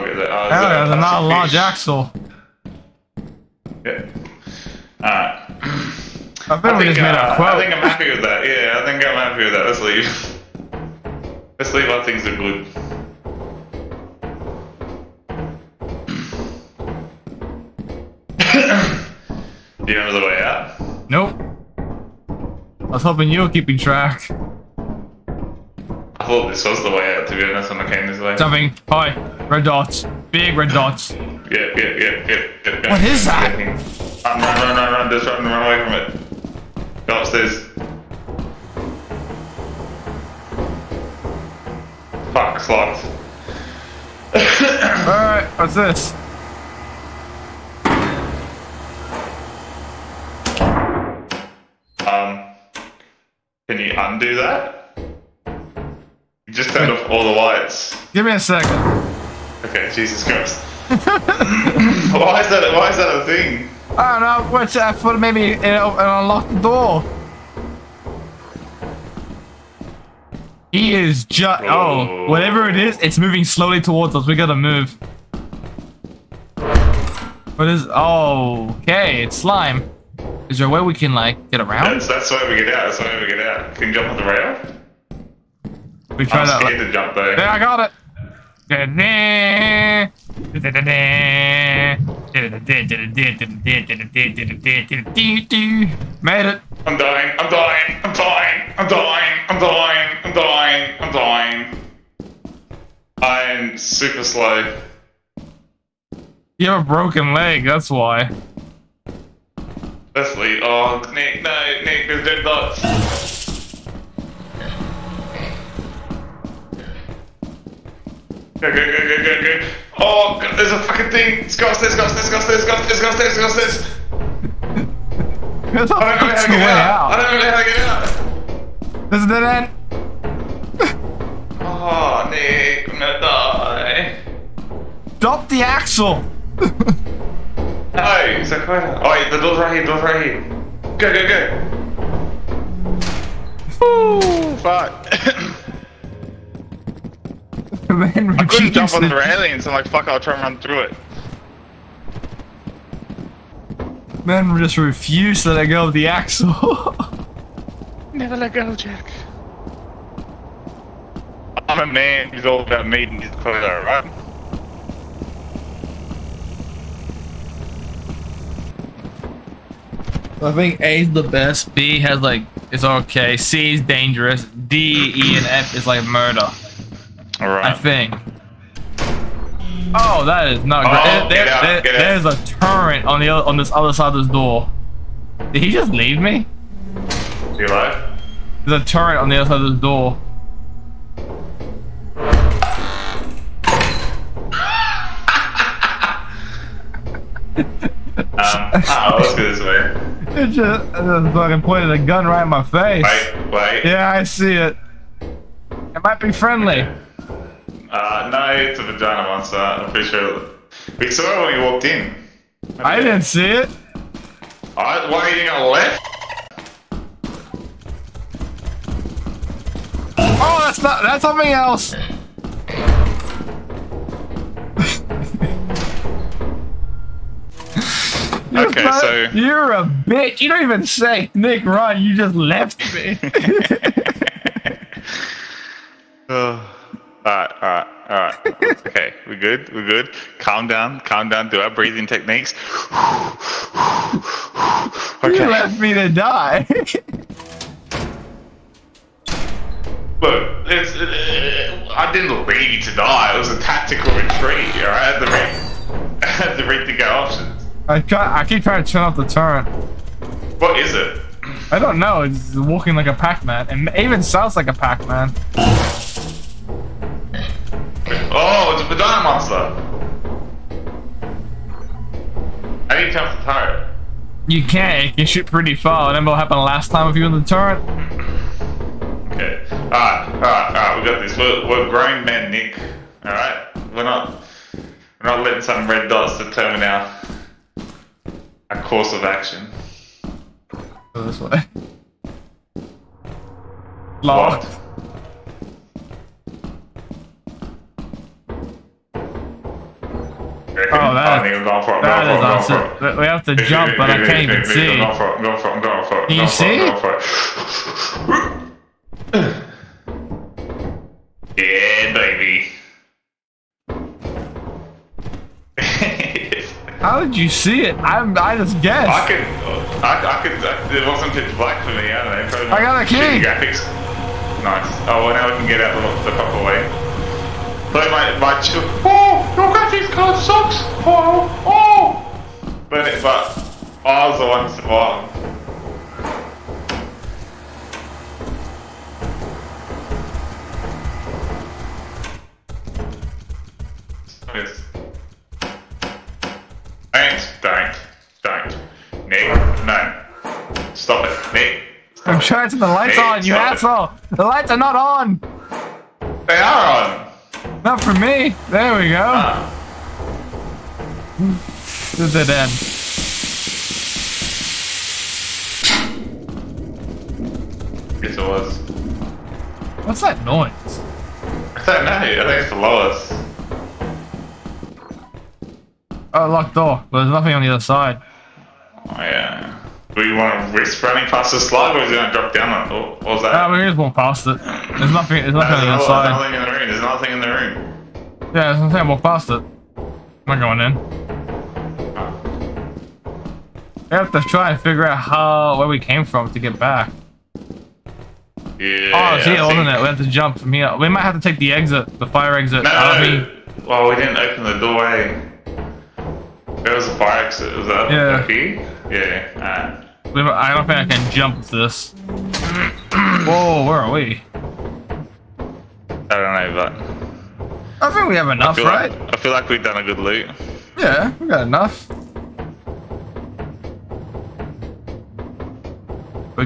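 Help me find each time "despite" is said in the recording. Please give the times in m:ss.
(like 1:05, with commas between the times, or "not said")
not said.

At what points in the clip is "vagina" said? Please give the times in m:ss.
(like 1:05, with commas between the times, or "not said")
3:28, 4:28.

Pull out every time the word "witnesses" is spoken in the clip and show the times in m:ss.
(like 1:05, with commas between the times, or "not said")
not said.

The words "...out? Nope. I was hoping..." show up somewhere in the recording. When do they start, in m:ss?
0:20.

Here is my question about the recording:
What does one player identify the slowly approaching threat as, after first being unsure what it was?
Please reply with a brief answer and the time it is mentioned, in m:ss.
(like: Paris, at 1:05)
Slime, at 1:19.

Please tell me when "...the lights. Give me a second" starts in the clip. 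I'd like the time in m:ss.
0:57.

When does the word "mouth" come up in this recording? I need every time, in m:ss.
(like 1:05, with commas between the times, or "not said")
not said.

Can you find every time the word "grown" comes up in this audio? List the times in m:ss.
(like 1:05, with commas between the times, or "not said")
4:41.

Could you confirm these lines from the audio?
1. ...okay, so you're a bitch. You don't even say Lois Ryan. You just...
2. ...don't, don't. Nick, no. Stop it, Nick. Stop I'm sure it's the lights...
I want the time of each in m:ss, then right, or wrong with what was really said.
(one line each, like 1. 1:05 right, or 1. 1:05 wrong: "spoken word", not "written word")
1. 3:48 wrong: "Nick", not "Lois"
2. 5:48 right.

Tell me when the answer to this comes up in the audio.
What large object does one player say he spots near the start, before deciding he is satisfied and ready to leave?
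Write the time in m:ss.
0:01.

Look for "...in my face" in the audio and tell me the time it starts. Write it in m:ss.
3:22.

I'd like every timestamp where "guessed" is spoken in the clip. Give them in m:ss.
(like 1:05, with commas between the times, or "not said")
5:18.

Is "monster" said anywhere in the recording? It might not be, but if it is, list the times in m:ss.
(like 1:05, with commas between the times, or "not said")
3:29, 4:29.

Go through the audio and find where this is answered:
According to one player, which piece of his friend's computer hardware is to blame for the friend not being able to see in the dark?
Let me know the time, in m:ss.
5:29.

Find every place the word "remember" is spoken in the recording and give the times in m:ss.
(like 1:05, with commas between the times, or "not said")
0:19, 4:36.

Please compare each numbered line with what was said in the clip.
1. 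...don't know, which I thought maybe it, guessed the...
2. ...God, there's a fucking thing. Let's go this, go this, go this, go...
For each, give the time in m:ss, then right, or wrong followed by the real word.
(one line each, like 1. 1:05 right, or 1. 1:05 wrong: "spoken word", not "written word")
1. 1:04 wrong: "unlocked", not "guessed"
2. 2:00 right.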